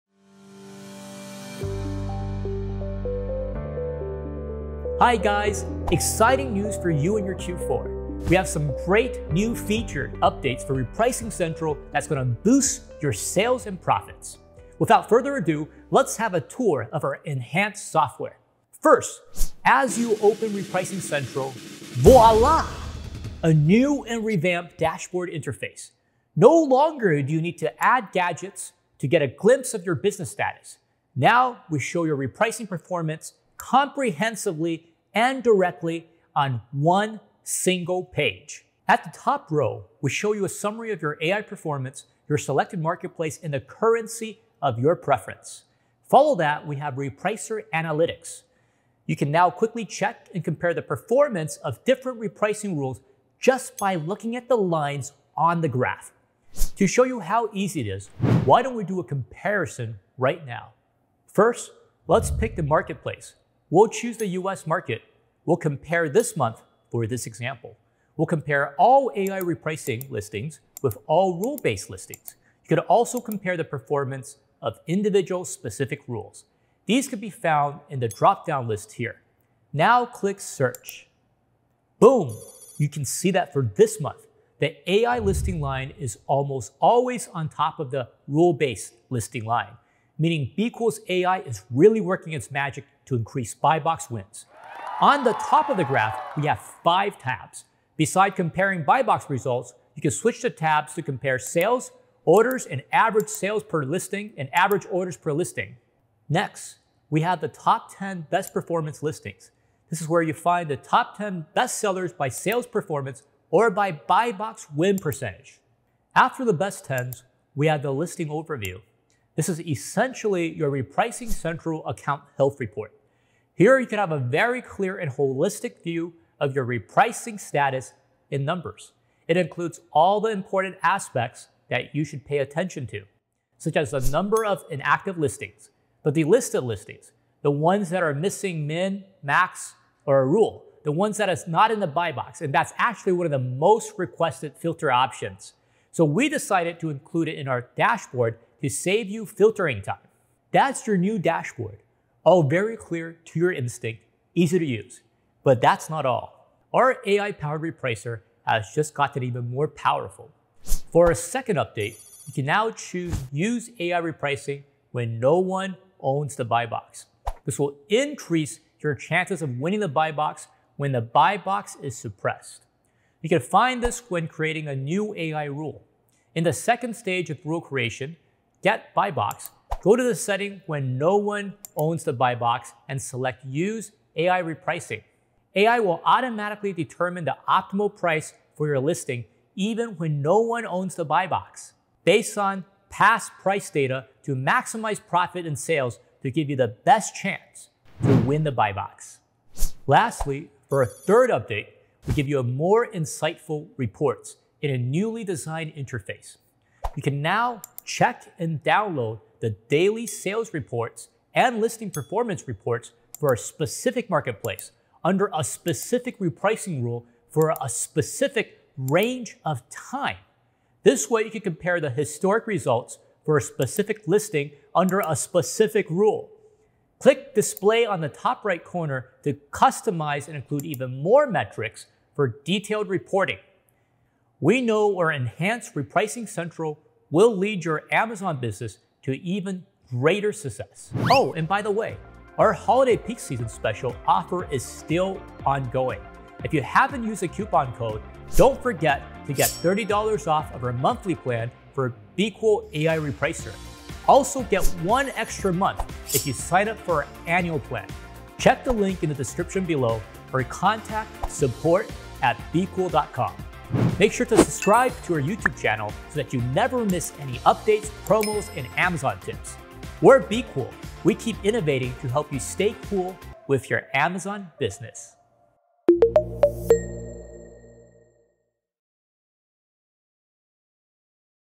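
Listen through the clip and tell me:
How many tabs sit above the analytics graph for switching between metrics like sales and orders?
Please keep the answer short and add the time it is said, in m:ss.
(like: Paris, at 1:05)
5, at 1:36.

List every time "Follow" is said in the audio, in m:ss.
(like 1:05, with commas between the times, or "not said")
0:46.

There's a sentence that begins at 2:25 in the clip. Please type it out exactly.
So we decided to include it in our dashboard to save you filtering time.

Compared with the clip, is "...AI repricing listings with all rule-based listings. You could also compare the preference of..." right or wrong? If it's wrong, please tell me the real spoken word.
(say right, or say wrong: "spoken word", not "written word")
wrong: "performance", not "preference".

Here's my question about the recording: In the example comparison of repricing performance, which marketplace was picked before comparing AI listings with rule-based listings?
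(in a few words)
US market.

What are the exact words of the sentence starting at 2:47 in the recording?
This will increase your chances of winning the buy box when the buy box is suppressed.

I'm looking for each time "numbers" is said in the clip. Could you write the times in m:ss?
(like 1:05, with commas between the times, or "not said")
2:08, 2:14.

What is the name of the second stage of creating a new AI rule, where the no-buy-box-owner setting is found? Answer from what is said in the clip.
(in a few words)
get buy box.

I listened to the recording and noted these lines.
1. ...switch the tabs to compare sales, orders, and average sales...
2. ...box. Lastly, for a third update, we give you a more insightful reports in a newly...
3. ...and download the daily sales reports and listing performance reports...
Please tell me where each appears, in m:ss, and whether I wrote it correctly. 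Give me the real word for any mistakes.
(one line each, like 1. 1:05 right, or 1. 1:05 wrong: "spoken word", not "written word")
1. 1:40 right
2. 3:18 right
3. 3:28 right.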